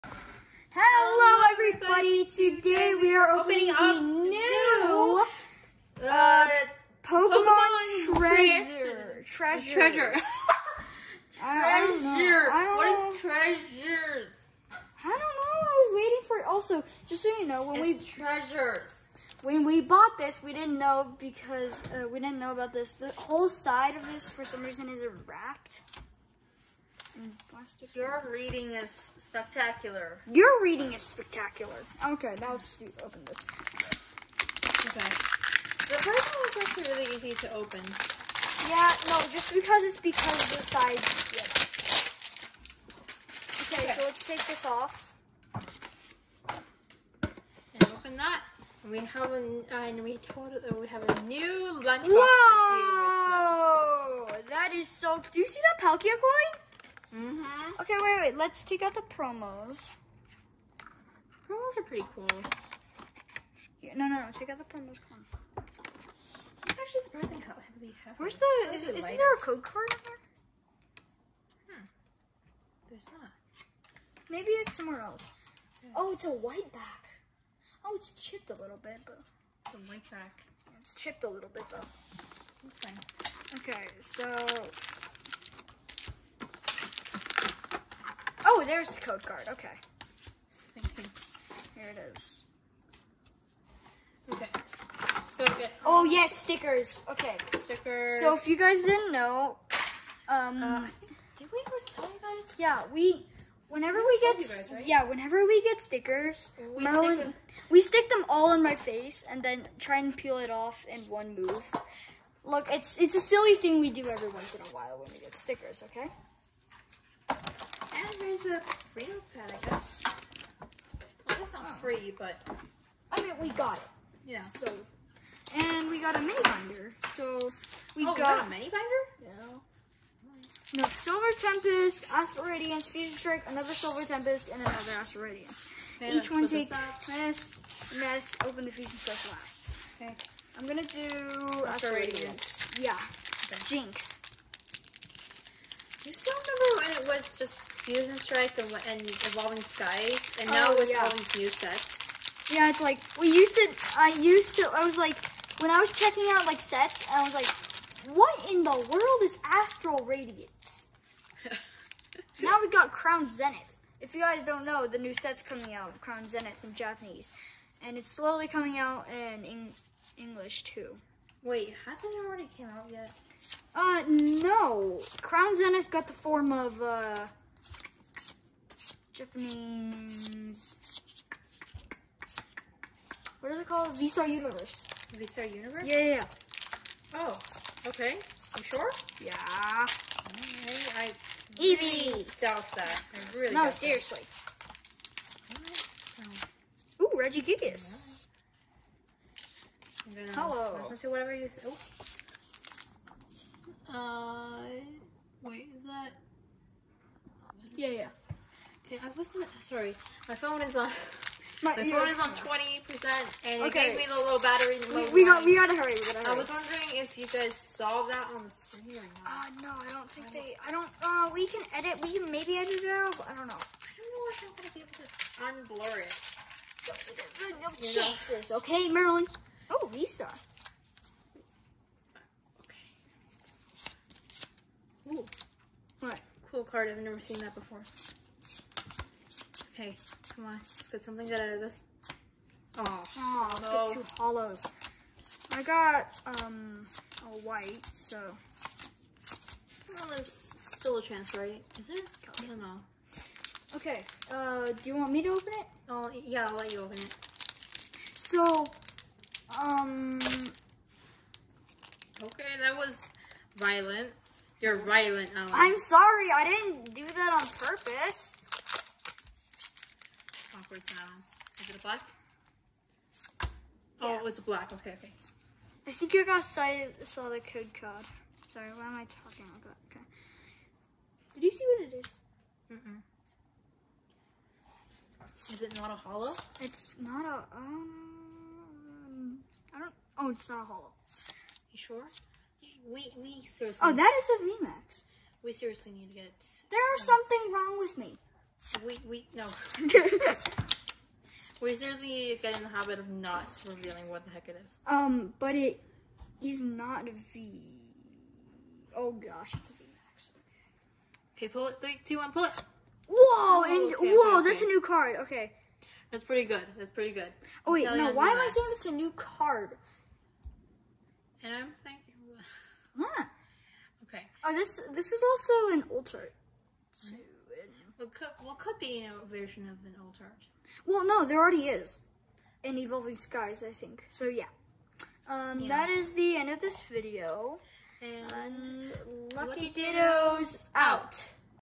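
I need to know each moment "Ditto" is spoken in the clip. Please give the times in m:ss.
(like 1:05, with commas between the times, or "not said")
5:39.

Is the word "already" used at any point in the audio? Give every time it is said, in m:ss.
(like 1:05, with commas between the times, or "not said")
2:52, 5:31.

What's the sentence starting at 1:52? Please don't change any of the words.
Look, it's it's a silly thing we do every once in a while when we get stickers, okay?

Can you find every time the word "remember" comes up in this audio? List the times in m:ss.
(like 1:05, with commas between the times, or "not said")
2:26.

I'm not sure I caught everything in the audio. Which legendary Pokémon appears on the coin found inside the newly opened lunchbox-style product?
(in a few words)
Palkia.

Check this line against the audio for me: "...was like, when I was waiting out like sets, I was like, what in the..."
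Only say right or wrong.
wrong.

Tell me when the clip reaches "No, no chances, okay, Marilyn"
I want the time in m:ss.
3:47.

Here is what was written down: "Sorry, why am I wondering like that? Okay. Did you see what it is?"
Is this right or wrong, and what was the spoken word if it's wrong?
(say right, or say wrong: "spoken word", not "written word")
wrong: "talking", not "wondering".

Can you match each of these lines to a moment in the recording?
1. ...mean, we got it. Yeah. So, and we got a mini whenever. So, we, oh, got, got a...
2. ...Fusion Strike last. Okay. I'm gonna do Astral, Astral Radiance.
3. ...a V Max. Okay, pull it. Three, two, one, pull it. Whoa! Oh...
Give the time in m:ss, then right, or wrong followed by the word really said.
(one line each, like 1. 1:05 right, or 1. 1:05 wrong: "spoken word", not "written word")
1. 2:03 wrong: "binder", not "whenever"
2. 2:18 right
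3. 5:09 right.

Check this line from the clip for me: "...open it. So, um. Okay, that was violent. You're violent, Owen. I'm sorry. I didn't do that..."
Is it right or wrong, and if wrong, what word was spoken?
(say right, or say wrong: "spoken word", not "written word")
right.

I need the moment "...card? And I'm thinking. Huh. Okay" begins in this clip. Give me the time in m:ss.
5:19.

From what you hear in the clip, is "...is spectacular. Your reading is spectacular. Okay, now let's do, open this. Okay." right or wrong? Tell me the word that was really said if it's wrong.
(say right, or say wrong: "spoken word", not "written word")
right.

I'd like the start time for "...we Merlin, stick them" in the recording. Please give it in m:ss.
1:46.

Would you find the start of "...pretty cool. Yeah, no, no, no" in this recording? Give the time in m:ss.
1:01.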